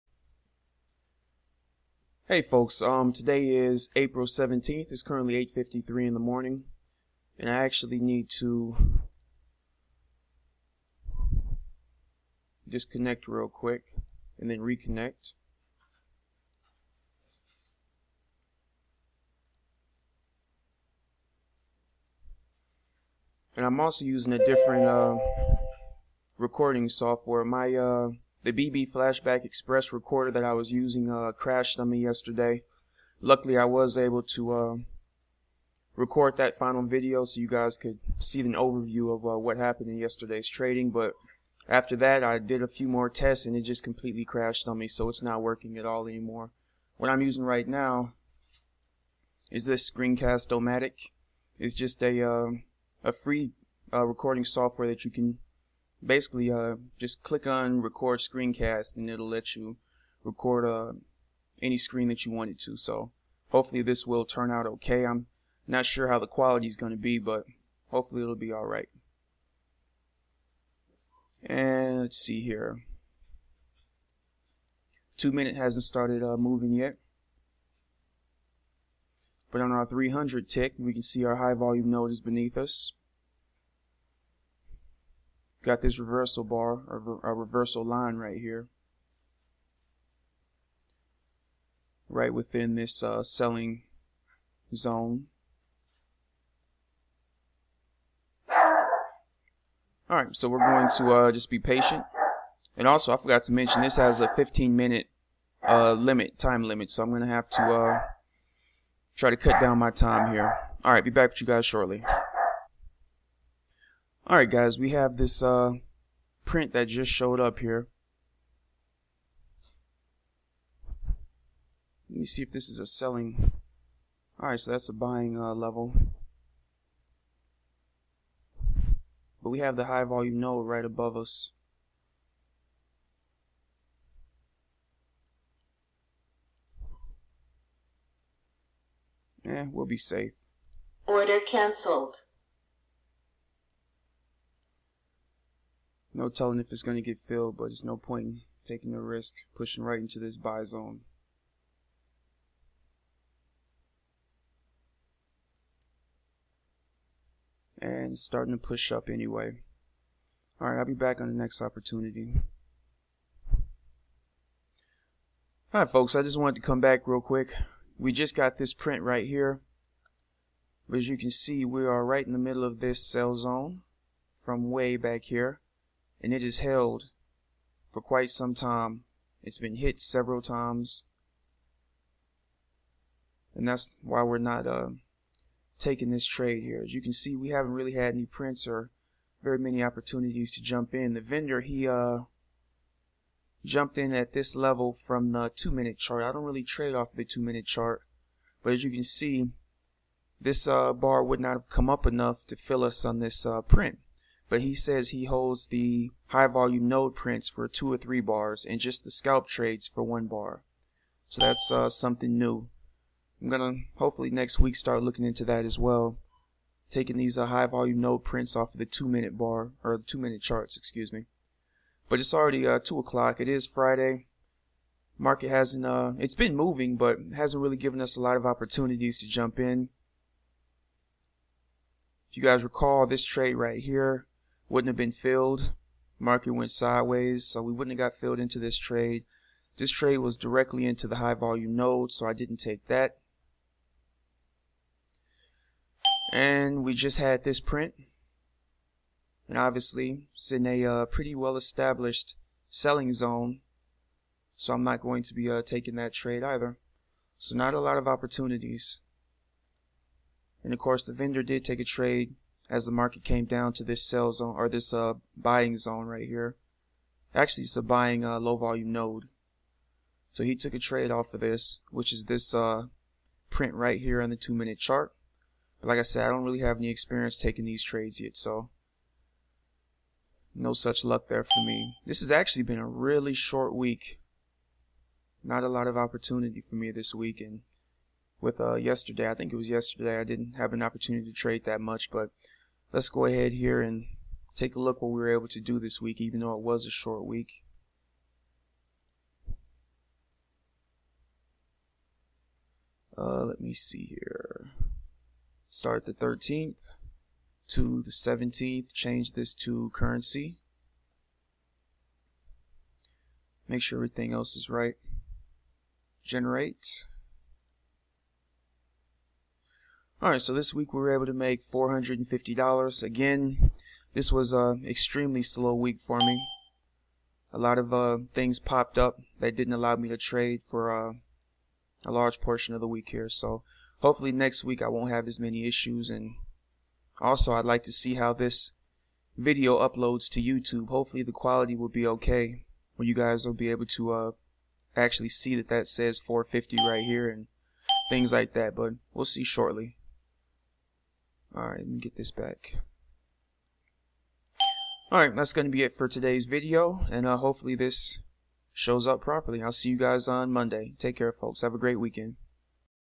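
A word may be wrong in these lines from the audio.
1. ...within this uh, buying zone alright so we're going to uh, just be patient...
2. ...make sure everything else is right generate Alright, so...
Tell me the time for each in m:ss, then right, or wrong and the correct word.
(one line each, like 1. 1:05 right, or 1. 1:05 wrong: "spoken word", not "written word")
1. 1:32 wrong: "selling", not "buying"
2. 5:13 right.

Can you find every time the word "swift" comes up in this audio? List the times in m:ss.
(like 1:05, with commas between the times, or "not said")
not said.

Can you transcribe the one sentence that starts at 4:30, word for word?
So he took a trade off of this, which is this uh, print right here on the two minute chart.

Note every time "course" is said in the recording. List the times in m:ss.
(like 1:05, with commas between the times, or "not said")
4:20.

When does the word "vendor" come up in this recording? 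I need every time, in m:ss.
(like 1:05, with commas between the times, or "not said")
3:11, 4:21.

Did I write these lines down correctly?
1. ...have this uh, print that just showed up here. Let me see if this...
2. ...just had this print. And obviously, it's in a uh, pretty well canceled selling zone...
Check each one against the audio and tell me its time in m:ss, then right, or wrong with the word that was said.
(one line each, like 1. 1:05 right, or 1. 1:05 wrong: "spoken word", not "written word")
1. 1:54 right
2. 4:06 wrong: "established", not "canceled".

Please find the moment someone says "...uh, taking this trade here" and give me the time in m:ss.
3:04.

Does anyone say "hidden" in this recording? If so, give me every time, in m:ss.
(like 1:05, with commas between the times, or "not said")
not said.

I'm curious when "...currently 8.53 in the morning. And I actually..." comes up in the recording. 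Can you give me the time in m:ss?
0:05.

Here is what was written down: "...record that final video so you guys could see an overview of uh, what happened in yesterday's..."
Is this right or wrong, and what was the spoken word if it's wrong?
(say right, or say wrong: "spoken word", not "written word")
right.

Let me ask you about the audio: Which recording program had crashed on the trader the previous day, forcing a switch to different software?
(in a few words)
BB Flashback Express.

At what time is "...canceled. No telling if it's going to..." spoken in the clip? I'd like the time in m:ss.
2:21.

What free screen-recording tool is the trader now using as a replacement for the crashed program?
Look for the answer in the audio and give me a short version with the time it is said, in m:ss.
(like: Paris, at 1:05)
Screencast-O-Matic, at 0:49.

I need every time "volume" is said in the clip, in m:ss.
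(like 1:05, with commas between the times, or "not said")
1:21, 2:10, 3:26, 3:37, 4:01, 4:28.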